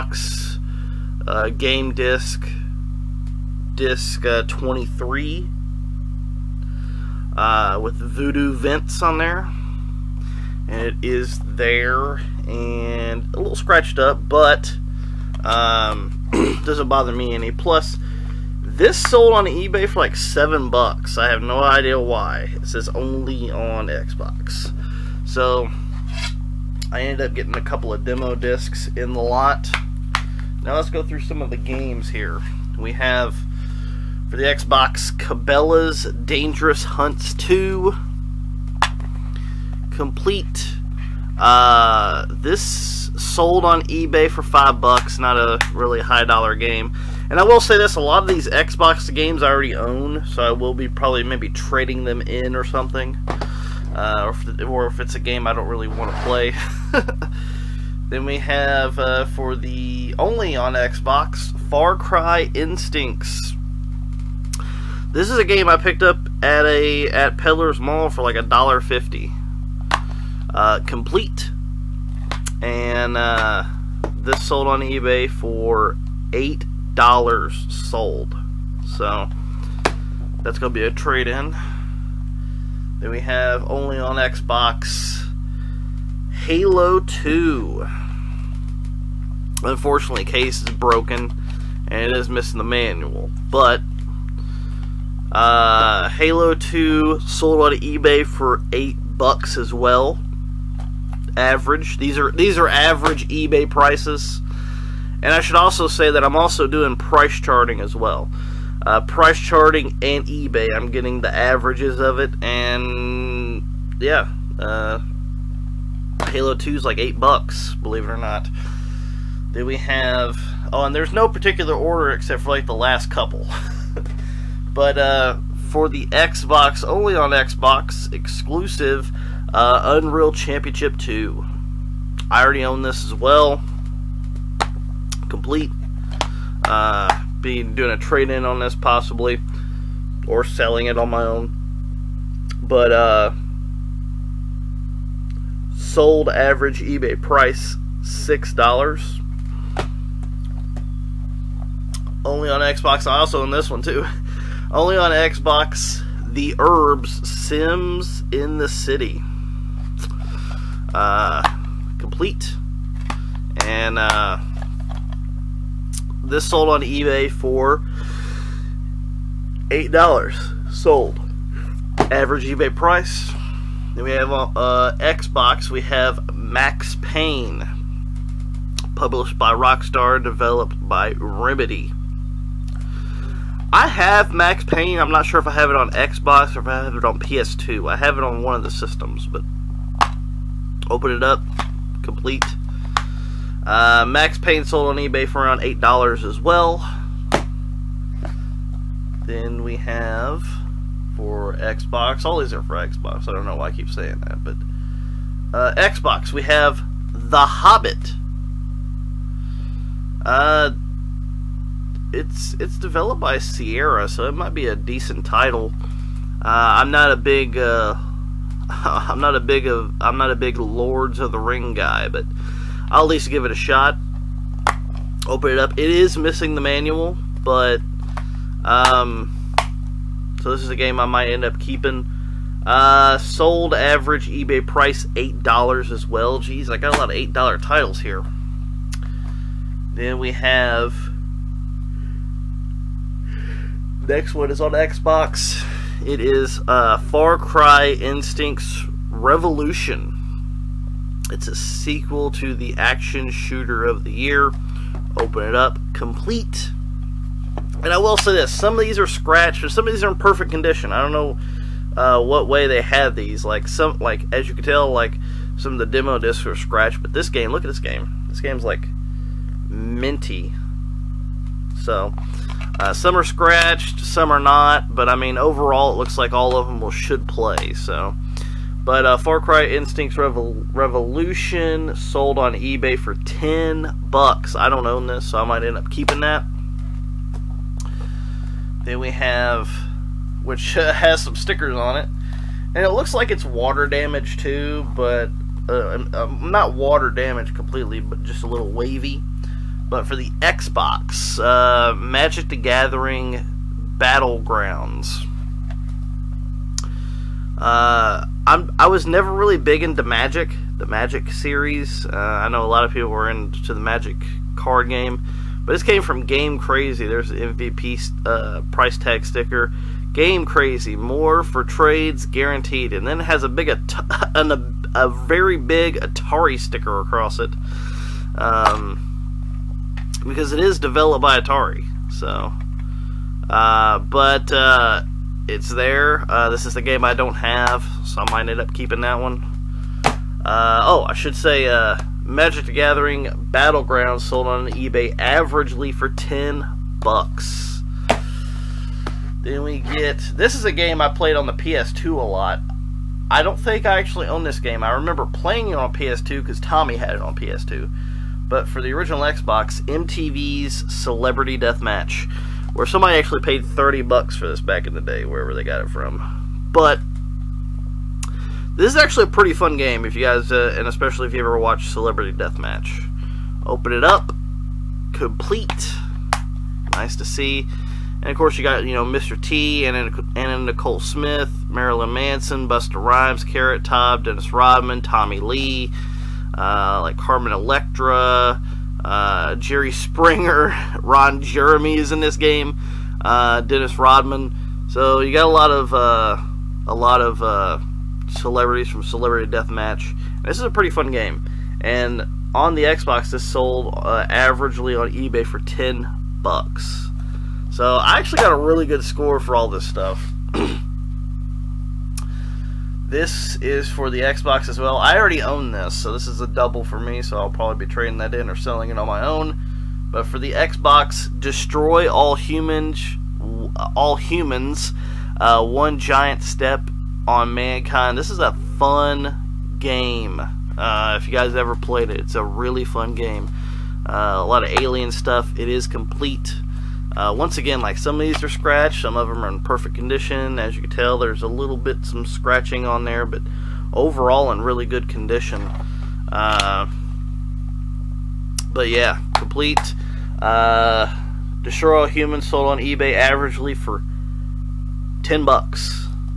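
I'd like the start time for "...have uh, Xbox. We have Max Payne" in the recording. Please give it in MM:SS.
02:54.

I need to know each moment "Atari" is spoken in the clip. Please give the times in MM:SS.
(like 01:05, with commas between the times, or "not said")
05:25, 05:31.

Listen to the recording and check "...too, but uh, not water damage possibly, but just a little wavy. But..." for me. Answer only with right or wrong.
wrong.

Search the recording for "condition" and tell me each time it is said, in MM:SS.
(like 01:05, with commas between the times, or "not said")
04:20, 07:19, 07:25.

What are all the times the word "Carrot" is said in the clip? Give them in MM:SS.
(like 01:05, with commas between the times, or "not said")
06:23.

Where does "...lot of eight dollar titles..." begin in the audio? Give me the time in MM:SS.
03:56.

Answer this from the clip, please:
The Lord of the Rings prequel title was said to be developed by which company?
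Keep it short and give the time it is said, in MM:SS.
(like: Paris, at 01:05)
Sierra, at 03:33.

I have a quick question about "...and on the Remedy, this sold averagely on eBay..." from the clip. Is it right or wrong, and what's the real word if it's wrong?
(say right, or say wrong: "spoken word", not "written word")
wrong: "Xbox", not "Remedy".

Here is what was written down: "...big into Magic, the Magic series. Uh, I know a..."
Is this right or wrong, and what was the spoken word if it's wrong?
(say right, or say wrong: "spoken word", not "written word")
right.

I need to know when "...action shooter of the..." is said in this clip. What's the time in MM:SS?
04:12.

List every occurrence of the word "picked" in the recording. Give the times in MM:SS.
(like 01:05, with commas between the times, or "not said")
01:05.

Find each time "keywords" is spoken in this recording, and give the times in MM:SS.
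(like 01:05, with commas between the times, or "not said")
not said.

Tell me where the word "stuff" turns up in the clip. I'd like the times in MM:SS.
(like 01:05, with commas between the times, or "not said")
06:49, 07:15.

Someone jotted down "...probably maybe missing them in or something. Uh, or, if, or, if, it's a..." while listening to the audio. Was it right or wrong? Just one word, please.
wrong.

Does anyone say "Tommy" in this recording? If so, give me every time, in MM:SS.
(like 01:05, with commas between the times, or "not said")
05:56, 06:25.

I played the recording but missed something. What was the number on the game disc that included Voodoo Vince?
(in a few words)
23.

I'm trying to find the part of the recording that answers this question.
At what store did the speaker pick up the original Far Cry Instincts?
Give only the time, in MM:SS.
01:07.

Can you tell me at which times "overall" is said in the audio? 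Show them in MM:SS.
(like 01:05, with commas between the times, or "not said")
04:35, 07:23.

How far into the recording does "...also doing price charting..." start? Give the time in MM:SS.
01:46.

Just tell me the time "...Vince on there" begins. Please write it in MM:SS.
00:08.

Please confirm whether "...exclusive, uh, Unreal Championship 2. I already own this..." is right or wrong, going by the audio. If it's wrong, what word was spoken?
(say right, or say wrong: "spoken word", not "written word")
right.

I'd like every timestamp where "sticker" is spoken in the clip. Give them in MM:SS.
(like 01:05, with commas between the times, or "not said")
04:51, 05:19, 05:26.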